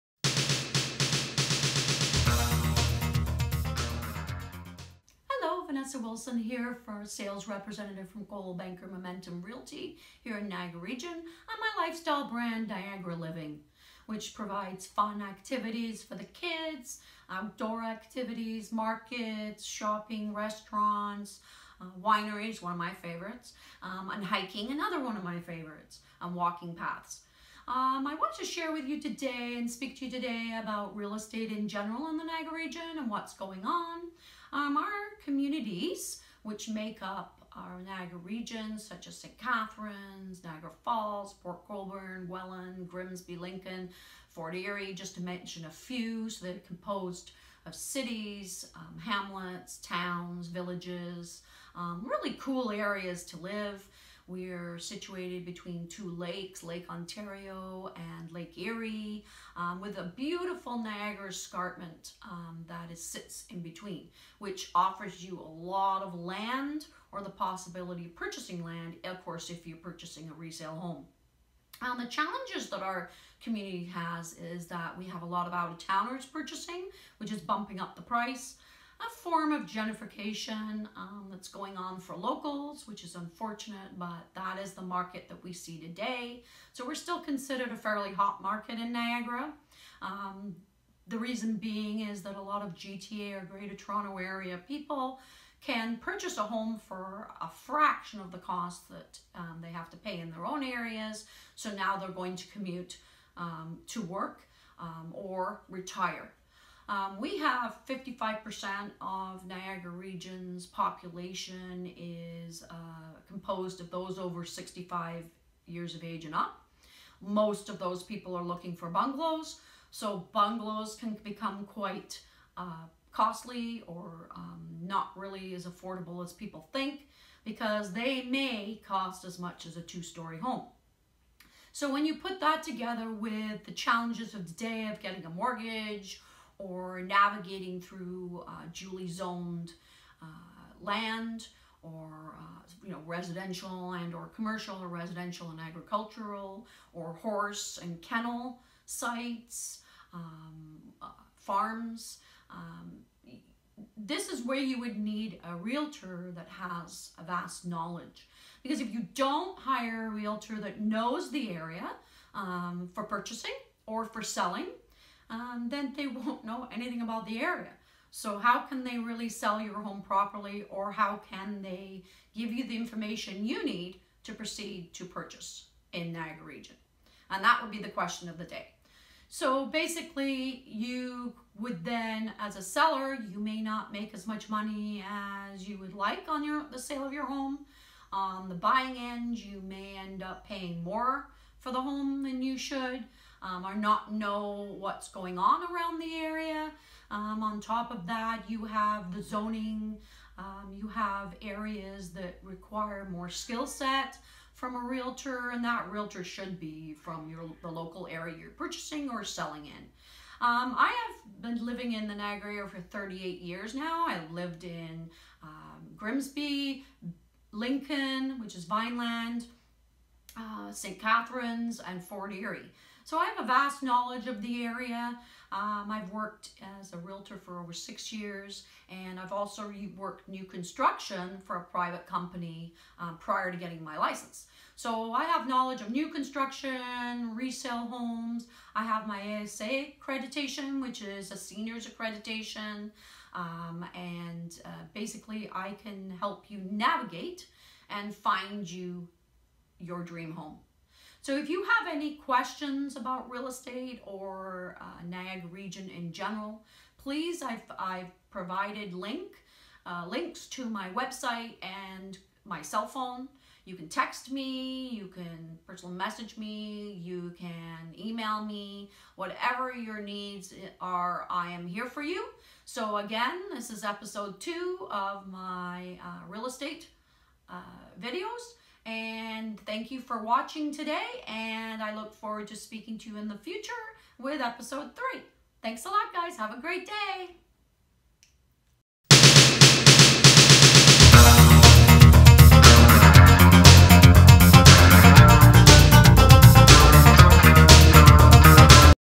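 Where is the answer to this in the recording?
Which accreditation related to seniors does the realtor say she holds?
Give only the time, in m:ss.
3:59.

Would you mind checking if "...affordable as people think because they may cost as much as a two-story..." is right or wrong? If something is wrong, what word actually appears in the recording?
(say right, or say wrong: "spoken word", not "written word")
right.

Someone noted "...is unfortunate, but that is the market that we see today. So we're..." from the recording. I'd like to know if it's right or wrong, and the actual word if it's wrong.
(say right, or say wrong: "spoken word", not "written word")
right.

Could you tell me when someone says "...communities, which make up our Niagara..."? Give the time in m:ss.
0:35.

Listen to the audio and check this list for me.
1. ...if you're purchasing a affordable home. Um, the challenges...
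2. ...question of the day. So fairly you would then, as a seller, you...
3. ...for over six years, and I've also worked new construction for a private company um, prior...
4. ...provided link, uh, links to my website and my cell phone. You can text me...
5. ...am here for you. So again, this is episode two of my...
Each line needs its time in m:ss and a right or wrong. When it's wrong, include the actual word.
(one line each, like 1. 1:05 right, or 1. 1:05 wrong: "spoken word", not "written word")
1. 1:09 wrong: "resale", not "affordable"
2. 2:57 wrong: "basically", not "fairly"
3. 3:47 right
4. 4:18 right
5. 4:31 right.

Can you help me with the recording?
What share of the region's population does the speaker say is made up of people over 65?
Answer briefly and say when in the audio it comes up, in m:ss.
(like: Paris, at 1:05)
55%, at 1:47.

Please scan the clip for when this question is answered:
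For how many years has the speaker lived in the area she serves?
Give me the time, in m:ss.
3:32.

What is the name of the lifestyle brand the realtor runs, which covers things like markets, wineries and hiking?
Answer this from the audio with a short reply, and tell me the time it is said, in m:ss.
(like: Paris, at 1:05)
Niagara Living, at 0:12.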